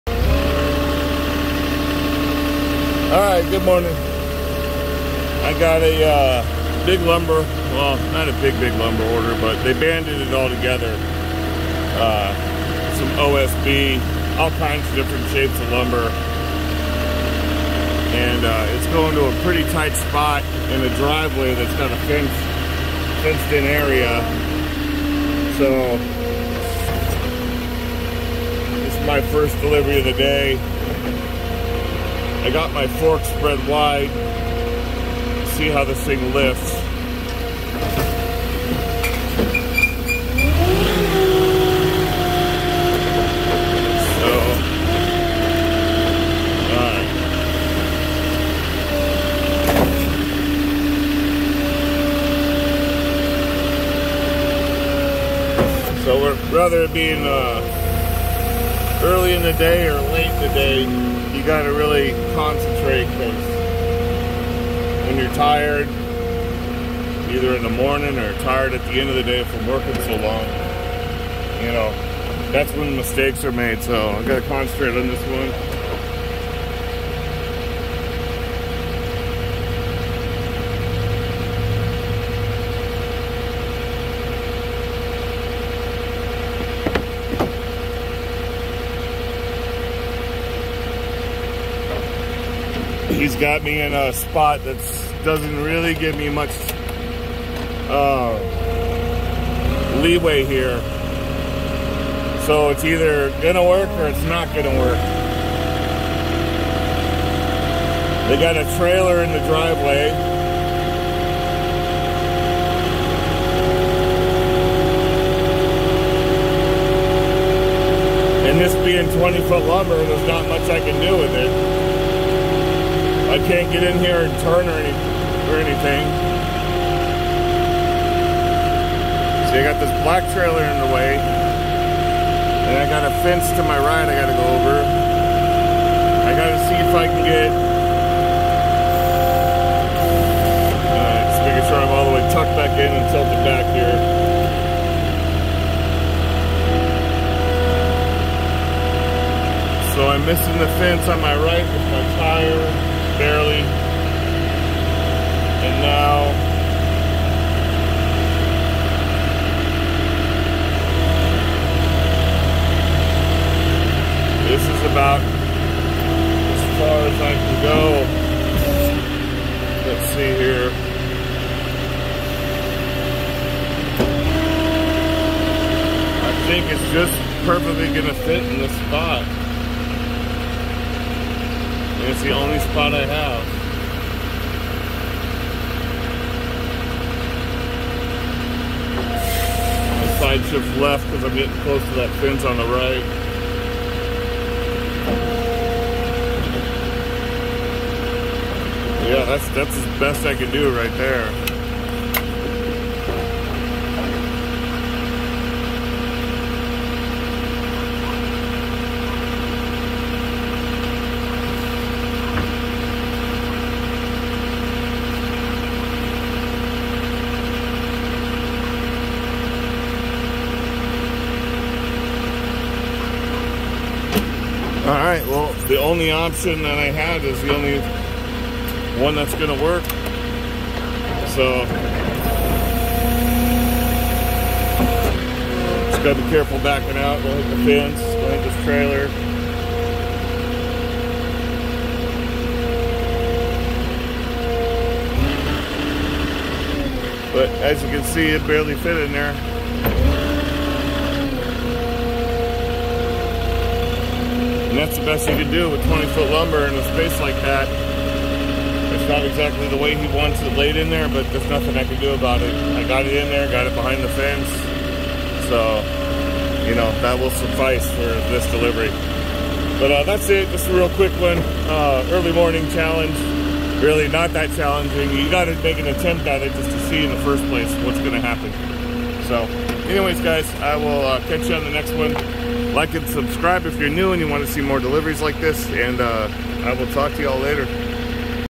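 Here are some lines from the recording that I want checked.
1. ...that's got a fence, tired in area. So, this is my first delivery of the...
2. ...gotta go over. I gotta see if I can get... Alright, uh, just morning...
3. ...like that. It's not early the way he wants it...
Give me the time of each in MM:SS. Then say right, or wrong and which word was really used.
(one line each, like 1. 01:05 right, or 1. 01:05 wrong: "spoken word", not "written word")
1. 00:21 wrong: "fenced", not "tired"
2. 02:14 wrong: "making", not "morning"
3. 04:17 wrong: "exactly", not "early".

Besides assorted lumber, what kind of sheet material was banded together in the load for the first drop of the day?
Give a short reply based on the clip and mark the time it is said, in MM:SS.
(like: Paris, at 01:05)
OSB, at 00:13.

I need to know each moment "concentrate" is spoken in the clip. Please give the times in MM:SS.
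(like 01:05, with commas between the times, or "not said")
01:02, 01:14.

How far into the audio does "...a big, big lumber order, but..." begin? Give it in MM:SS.
00:08.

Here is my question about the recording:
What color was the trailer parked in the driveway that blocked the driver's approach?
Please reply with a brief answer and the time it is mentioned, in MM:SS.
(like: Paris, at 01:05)
Black, at 02:10.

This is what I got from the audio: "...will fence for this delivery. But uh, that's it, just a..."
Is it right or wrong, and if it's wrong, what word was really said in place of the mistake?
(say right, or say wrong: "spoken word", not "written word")
wrong: "suffice", not "fence".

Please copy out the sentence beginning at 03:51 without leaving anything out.
So just got to be careful backing out.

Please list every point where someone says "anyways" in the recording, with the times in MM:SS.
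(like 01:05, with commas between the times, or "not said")
04:39.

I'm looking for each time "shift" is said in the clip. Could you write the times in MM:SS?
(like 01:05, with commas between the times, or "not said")
03:10.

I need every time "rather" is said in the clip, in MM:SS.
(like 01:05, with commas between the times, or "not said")
00:56.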